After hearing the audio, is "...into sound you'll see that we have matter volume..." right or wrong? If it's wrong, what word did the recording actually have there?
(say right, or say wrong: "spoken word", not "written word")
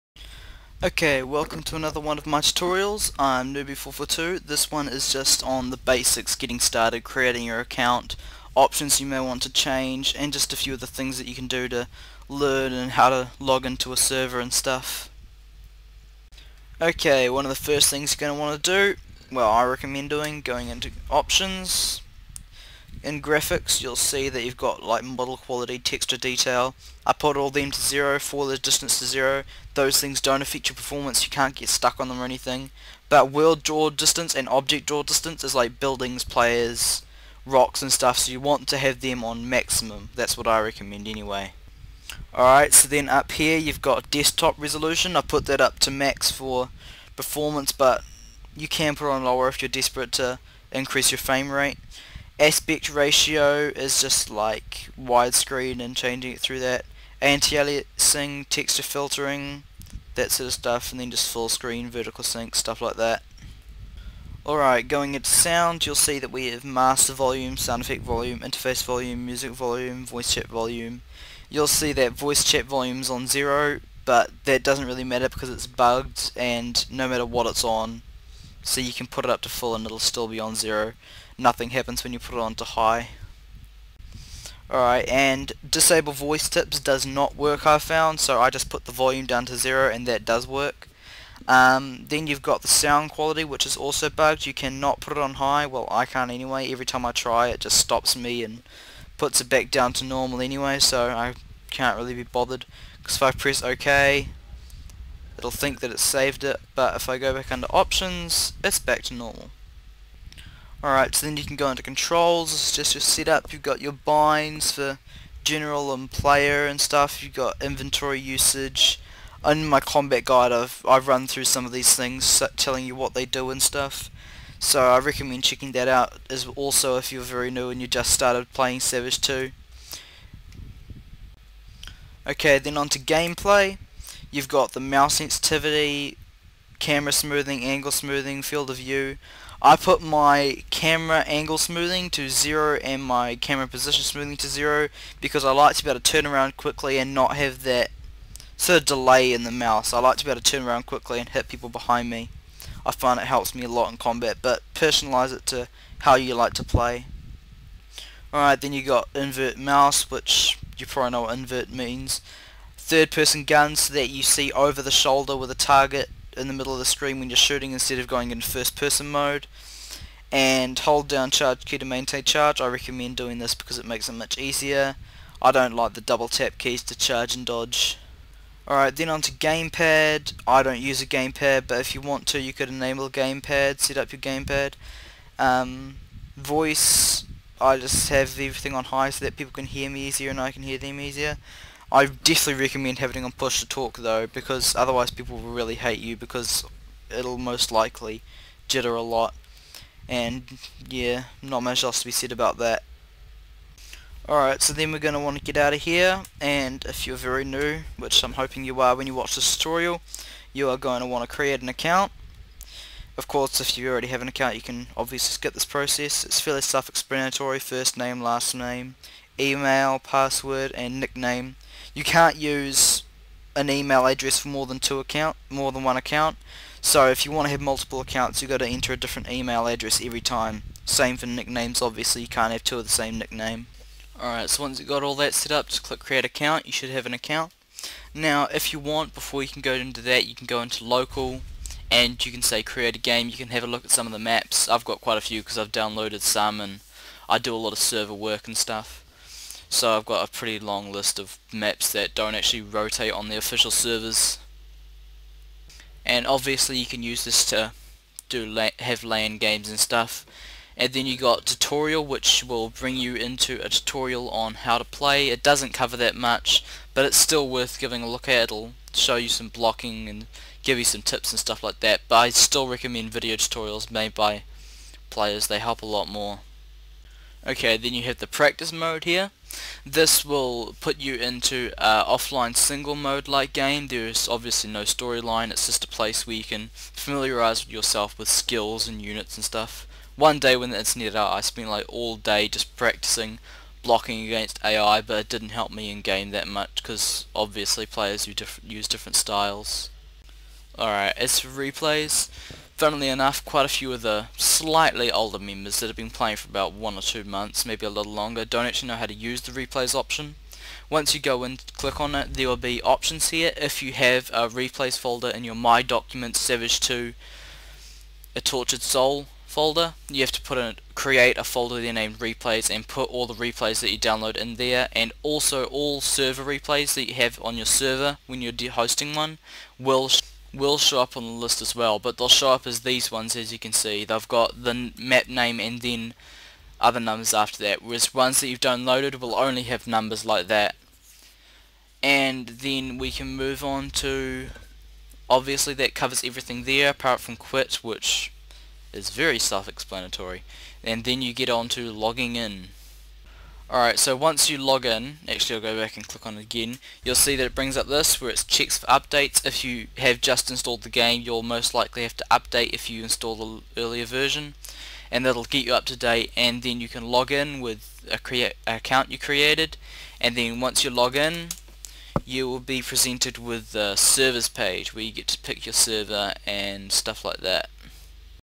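wrong: "master", not "matter".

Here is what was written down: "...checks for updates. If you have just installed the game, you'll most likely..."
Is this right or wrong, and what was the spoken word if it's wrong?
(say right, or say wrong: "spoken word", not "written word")
right.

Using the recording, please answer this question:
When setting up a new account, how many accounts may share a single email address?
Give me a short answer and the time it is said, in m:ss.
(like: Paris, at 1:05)
1, at 3:45.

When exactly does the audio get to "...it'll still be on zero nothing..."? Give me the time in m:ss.
1:19.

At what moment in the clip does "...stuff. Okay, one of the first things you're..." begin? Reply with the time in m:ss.
0:14.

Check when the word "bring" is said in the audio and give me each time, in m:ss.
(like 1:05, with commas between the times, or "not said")
4:22, 5:57.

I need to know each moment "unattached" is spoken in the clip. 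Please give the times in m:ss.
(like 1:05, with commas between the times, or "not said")
not said.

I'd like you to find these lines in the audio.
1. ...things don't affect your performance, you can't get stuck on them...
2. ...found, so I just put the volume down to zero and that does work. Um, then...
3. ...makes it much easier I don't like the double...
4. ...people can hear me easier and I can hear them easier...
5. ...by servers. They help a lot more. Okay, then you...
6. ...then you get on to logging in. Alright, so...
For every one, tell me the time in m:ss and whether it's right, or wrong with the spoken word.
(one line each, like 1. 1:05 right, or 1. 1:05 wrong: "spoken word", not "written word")
1. 0:29 right
2. 1:27 right
3. 2:53 right
4. 3:09 right
5. 4:34 wrong: "players", not "servers"
6. 5:51 right.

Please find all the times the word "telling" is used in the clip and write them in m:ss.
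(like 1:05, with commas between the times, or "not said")
2:02.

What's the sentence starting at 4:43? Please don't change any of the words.
There's obviously no storyline, it's just a place where you can familiarize yourself with skills and units and stuff.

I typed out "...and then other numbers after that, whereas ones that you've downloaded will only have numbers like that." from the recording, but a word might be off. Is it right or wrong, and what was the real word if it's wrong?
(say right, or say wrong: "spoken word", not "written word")
right.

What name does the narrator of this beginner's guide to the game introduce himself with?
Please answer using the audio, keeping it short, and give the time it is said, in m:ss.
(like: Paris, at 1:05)
Nooby442, at 0:03.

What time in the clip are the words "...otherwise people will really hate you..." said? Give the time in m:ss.
3:14.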